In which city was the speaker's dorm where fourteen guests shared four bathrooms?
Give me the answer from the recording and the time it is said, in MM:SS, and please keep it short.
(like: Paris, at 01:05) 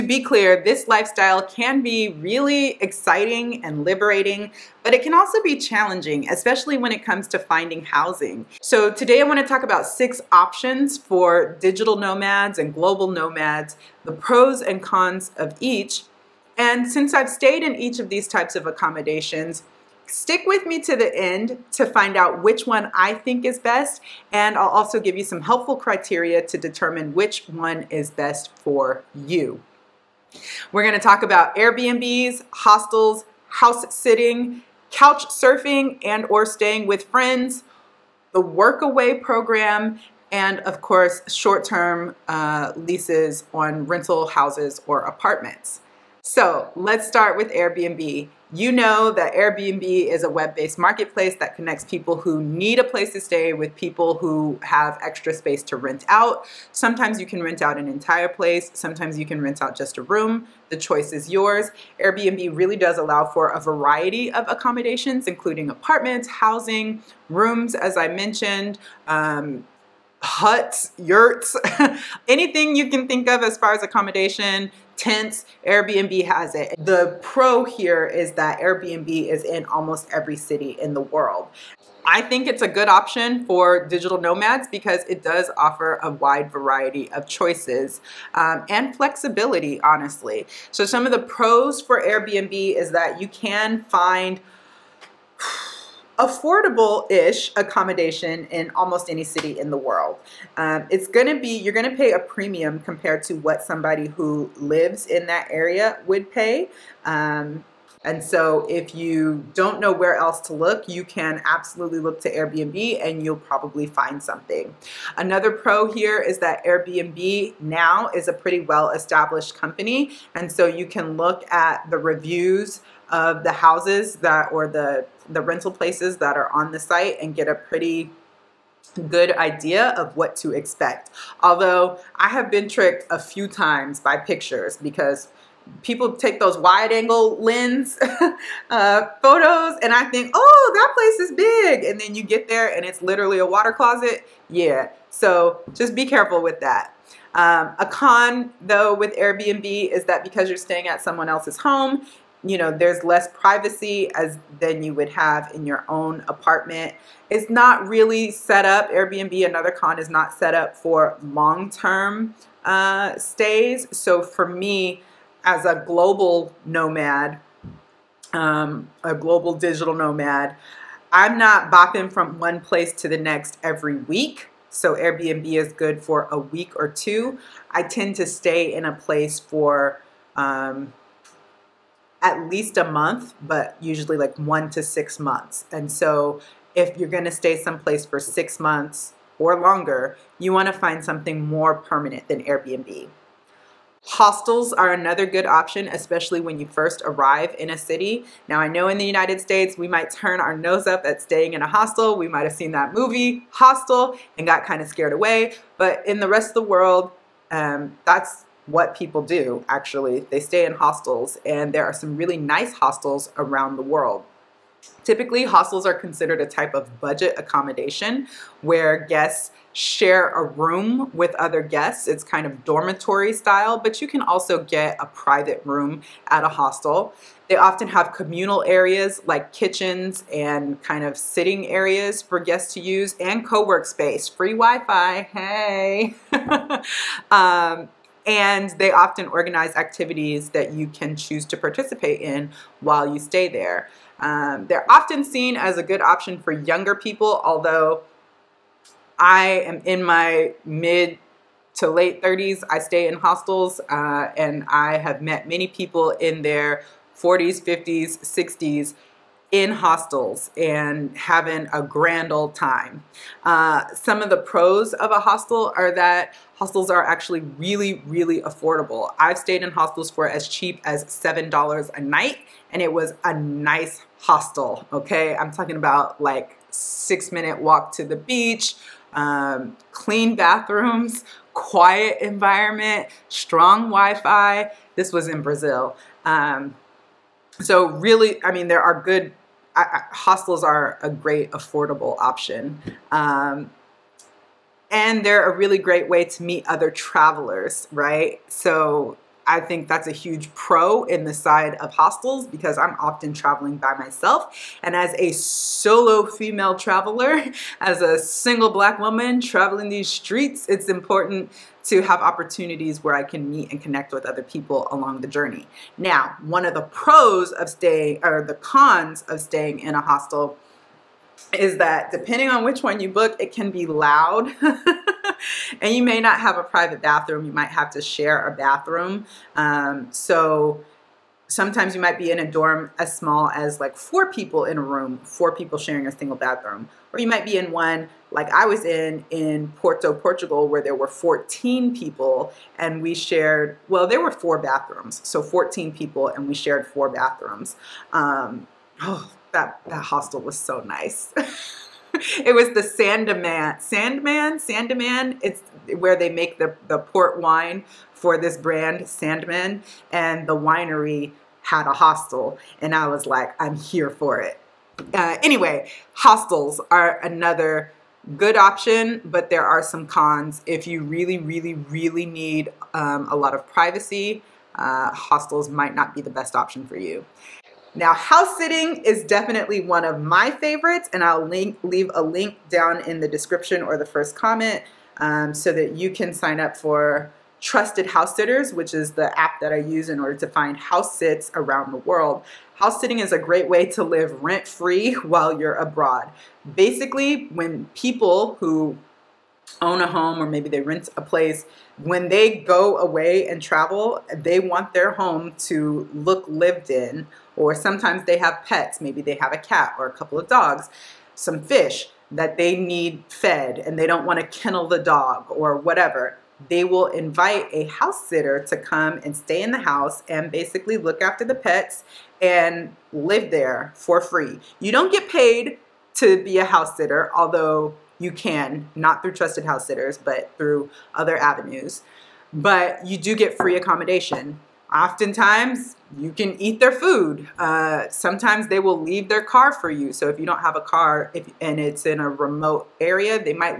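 Porto, Portugal, at 05:39.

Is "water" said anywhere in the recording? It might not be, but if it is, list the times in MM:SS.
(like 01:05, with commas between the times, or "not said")
02:23.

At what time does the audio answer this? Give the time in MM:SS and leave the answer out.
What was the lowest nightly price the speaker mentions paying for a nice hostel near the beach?
04:31.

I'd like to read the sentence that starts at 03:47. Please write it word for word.
They often have communal areas like kitchens and kind of sitting areas for guests to use and co-work space, free Wi-Fi, hey!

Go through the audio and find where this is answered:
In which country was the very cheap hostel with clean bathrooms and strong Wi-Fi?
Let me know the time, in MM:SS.
04:45.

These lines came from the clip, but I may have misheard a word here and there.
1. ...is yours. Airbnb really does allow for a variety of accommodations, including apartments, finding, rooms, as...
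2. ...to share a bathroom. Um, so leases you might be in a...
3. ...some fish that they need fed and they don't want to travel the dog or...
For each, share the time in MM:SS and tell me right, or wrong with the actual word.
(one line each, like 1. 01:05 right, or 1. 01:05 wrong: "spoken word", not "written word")
1. 01:01 wrong: "housing", not "finding"
2. 05:27 wrong: "sometimes", not "leases"
3. 06:51 wrong: "kennel", not "travel".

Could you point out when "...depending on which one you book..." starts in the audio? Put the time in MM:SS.
05:22.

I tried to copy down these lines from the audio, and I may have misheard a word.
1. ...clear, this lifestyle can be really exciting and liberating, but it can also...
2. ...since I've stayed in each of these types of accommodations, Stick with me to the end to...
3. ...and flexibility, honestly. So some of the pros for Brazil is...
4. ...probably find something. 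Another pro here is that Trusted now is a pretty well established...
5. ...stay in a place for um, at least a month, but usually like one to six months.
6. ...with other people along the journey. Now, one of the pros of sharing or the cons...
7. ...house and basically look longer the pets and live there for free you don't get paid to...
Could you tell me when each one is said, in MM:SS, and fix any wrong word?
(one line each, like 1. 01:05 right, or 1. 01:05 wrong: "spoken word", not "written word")
1. 00:00 right
2. 00:16 right
3. 01:28 wrong: "Airbnb", not "Brazil"
4. 01:53 wrong: "Airbnb", not "Trusted"
5. 02:58 right
6. 05:14 wrong: "staying", not "sharing"
7. 06:59 wrong: "after", not "longer".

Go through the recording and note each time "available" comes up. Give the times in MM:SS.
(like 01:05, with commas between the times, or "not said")
not said.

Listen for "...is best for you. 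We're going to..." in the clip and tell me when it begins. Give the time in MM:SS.
00:27.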